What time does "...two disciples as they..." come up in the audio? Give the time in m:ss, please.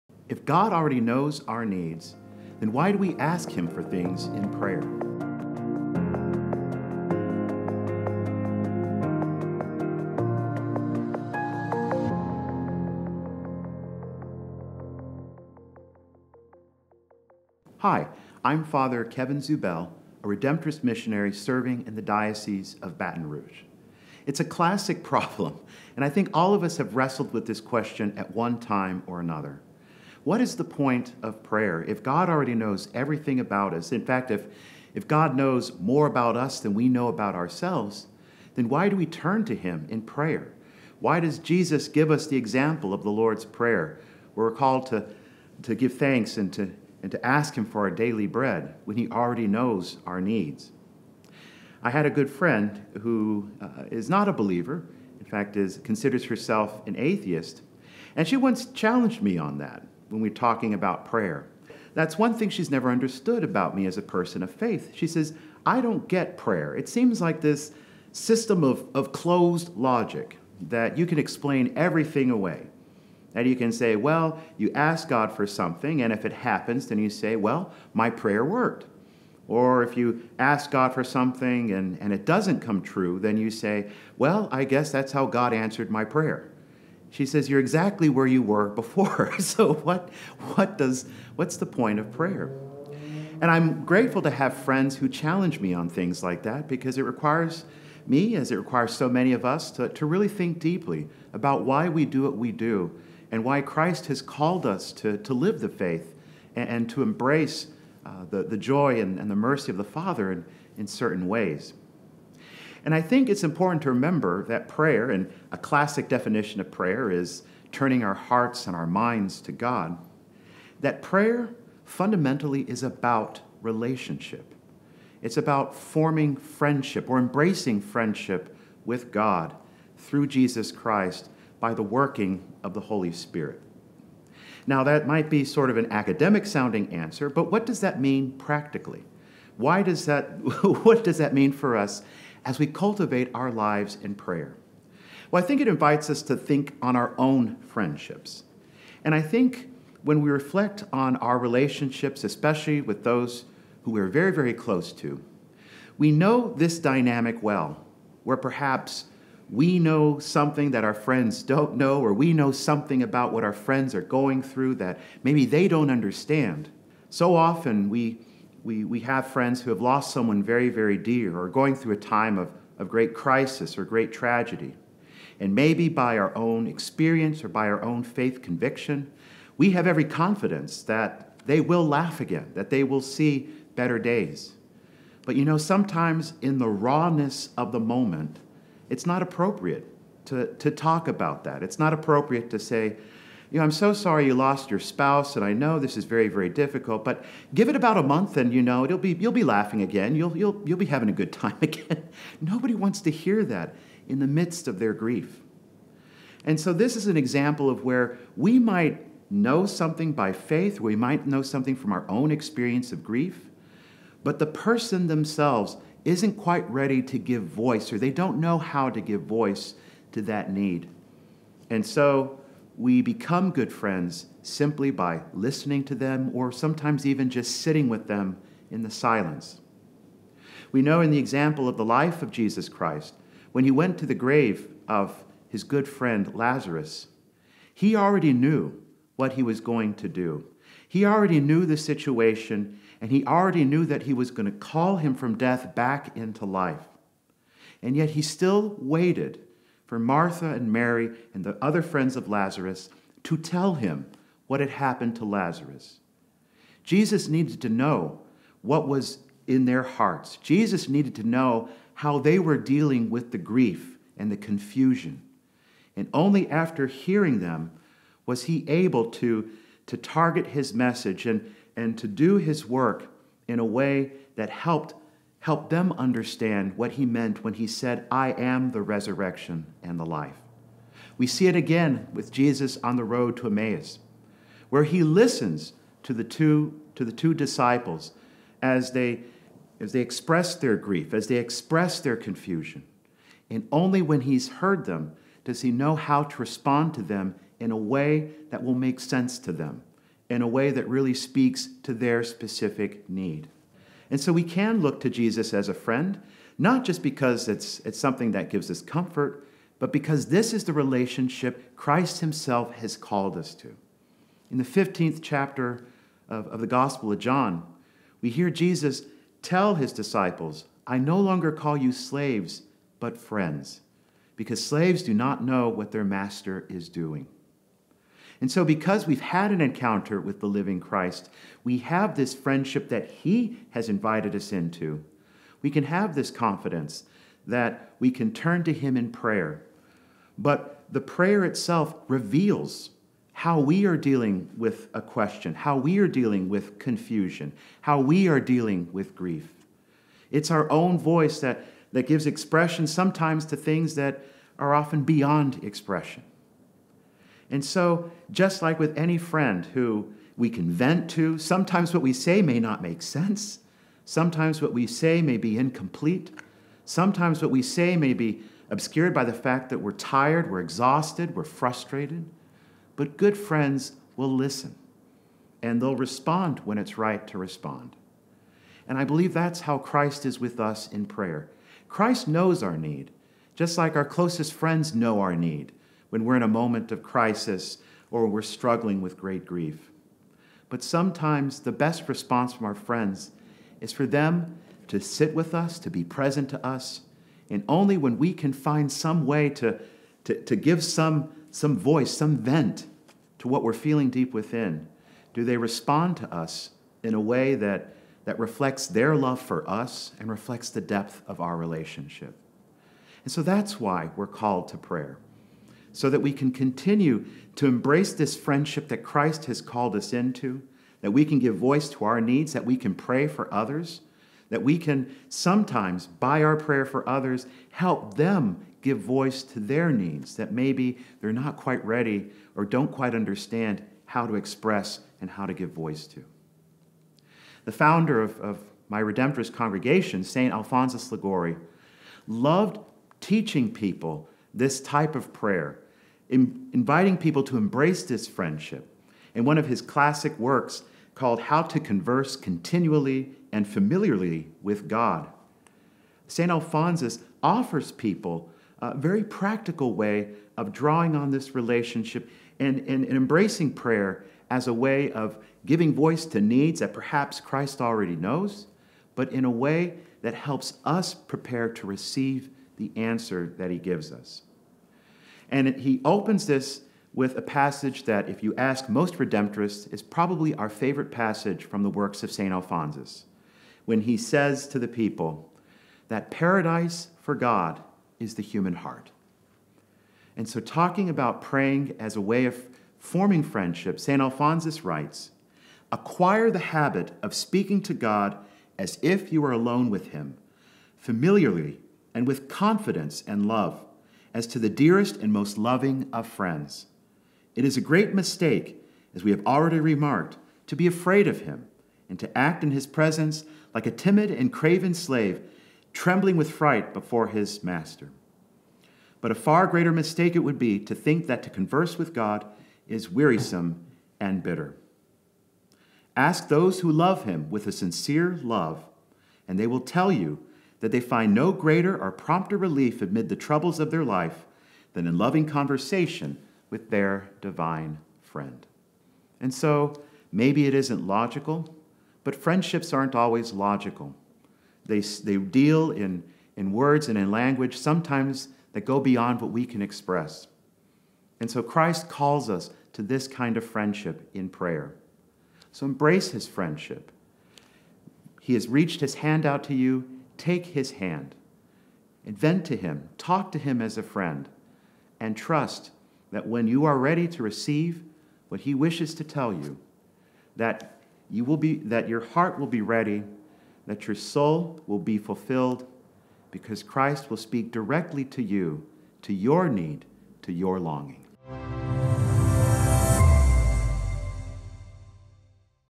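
4:47.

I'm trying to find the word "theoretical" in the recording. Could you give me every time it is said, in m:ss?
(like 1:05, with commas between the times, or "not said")
not said.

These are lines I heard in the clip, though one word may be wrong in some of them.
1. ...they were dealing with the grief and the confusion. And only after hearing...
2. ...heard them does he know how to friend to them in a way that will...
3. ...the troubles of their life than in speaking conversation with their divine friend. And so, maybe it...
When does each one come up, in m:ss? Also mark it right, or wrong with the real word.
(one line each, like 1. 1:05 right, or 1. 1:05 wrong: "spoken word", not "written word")
1. 4:22 right
2. 4:54 wrong: "respond", not "friend"
3. 8:53 wrong: "loving", not "speaking".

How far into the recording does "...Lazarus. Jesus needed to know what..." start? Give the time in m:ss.
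4:15.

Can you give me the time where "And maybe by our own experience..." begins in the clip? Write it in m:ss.
2:55.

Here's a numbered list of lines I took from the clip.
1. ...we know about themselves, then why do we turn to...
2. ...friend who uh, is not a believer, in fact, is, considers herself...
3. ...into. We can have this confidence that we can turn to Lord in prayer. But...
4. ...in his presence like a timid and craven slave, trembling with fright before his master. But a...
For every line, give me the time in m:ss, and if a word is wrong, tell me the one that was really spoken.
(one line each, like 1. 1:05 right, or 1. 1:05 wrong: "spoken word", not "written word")
1. 0:36 wrong: "ourselves", not "themselves"
2. 0:52 right
3. 5:34 wrong: "Him", not "Lord"
4. 8:32 right.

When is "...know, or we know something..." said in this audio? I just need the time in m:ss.
2:41.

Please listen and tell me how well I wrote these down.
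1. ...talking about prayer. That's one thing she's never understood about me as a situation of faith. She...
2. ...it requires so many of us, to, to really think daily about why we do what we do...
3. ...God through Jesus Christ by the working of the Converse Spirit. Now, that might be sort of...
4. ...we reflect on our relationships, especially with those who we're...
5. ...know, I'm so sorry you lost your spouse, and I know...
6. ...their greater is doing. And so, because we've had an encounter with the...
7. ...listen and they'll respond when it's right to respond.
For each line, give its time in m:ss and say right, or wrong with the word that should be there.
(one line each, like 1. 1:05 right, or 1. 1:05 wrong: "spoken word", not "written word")
1. 1:00 wrong: "person", not "situation"
2. 1:38 wrong: "deeply", not "daily"
3. 2:09 wrong: "Holy", not "Converse"
4. 2:30 right
5. 3:13 right
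6. 5:25 wrong: "master", not "greater"
7. 6:14 right.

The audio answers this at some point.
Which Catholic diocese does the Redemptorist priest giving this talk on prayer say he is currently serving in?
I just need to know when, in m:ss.
0:22.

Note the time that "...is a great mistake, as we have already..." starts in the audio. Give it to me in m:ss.
8:27.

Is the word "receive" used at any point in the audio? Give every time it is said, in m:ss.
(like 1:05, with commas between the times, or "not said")
7:51, 9:27.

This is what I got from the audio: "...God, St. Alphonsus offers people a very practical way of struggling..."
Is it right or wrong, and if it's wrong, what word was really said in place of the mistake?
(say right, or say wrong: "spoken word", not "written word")
wrong: "drawing", not "struggling".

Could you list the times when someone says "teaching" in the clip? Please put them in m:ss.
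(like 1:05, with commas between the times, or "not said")
7:23.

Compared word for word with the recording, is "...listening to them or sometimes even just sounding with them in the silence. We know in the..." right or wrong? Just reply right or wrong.
wrong.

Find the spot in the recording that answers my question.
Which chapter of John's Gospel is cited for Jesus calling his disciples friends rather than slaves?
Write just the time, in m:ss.
5:14.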